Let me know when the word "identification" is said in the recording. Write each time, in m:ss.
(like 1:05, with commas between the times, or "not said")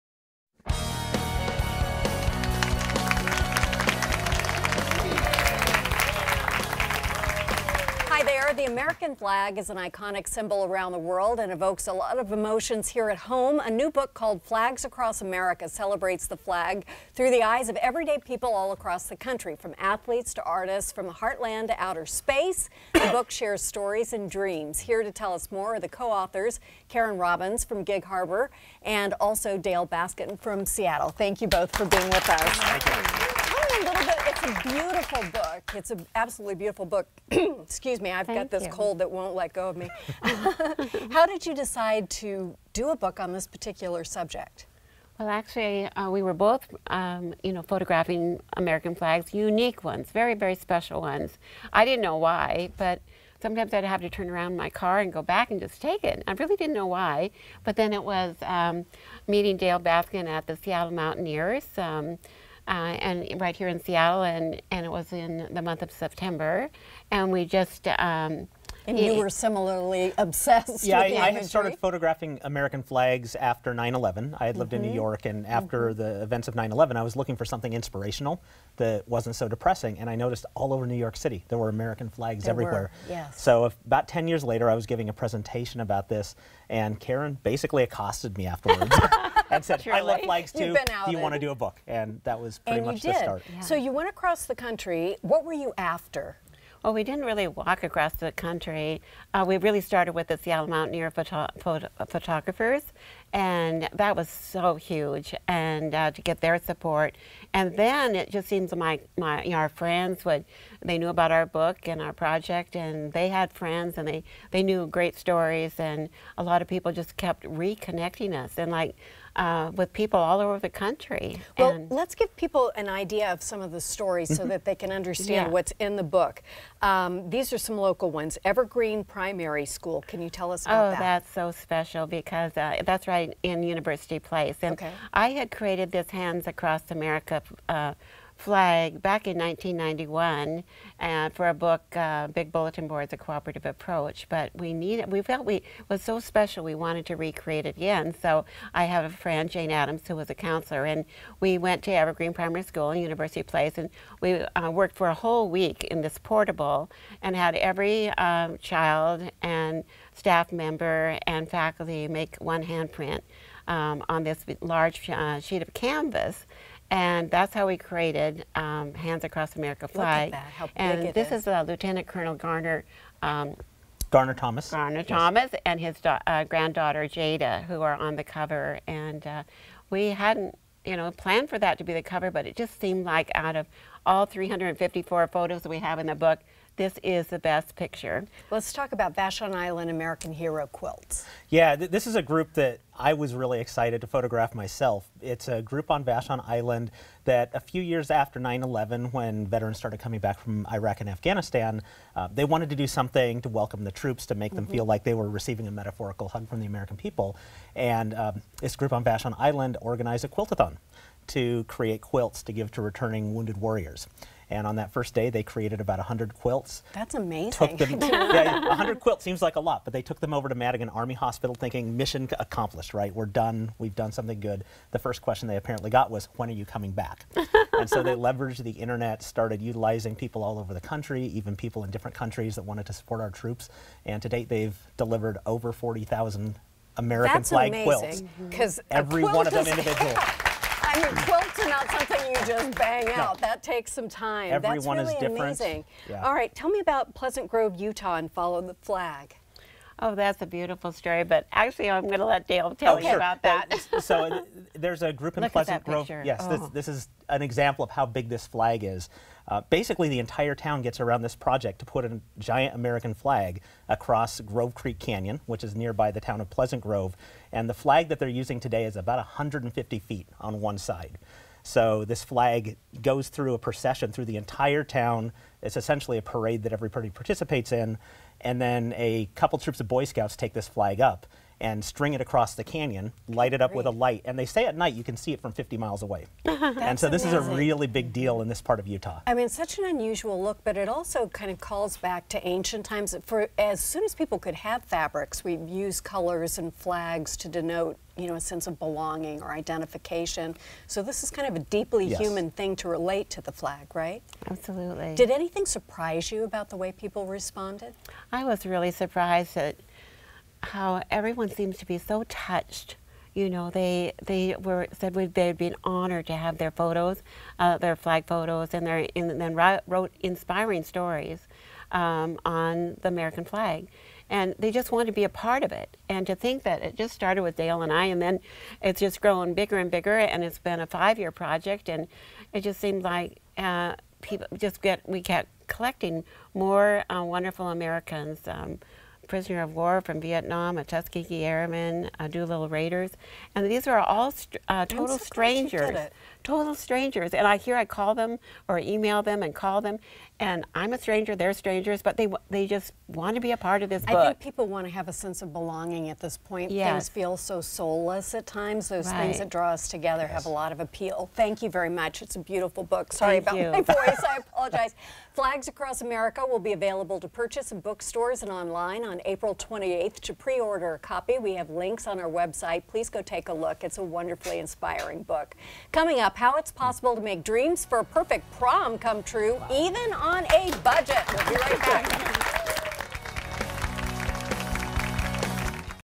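4:59.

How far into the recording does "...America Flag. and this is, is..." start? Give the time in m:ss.
2:49.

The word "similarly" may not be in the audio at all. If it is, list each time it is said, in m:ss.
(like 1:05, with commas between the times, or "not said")
1:09.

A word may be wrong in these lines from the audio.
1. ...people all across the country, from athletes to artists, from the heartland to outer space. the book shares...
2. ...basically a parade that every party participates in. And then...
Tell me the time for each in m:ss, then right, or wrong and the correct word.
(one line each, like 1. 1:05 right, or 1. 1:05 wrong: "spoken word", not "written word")
1. 0:18 right
2. 4:35 wrong: "essentially", not "basically".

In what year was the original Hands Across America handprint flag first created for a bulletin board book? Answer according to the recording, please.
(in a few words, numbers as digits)
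1991.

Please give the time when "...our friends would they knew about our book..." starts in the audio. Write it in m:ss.
1:49.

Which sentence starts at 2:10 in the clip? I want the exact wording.
Oh, that's so special because uh, that's right in University Place.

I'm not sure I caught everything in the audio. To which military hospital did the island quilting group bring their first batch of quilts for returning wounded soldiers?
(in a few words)
Madigan Army Hospital.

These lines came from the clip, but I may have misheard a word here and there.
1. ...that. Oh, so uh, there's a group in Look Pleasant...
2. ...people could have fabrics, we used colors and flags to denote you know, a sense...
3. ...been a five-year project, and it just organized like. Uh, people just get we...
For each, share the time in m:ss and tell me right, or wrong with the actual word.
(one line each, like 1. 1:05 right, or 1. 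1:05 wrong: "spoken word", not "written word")
1. 4:13 right
2. 4:54 right
3. 5:30 wrong: "seemed", not "organized".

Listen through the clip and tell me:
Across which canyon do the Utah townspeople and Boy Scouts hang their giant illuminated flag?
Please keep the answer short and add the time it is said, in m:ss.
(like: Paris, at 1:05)
Grove Creek Canyon, at 4:24.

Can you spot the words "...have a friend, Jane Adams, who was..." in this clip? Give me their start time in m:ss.
2:28.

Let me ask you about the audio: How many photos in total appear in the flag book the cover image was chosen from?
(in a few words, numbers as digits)
354.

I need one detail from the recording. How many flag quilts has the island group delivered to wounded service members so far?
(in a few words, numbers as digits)
over 40,000.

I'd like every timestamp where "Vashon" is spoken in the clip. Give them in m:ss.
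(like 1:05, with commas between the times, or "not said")
3:09, 3:16, 3:29.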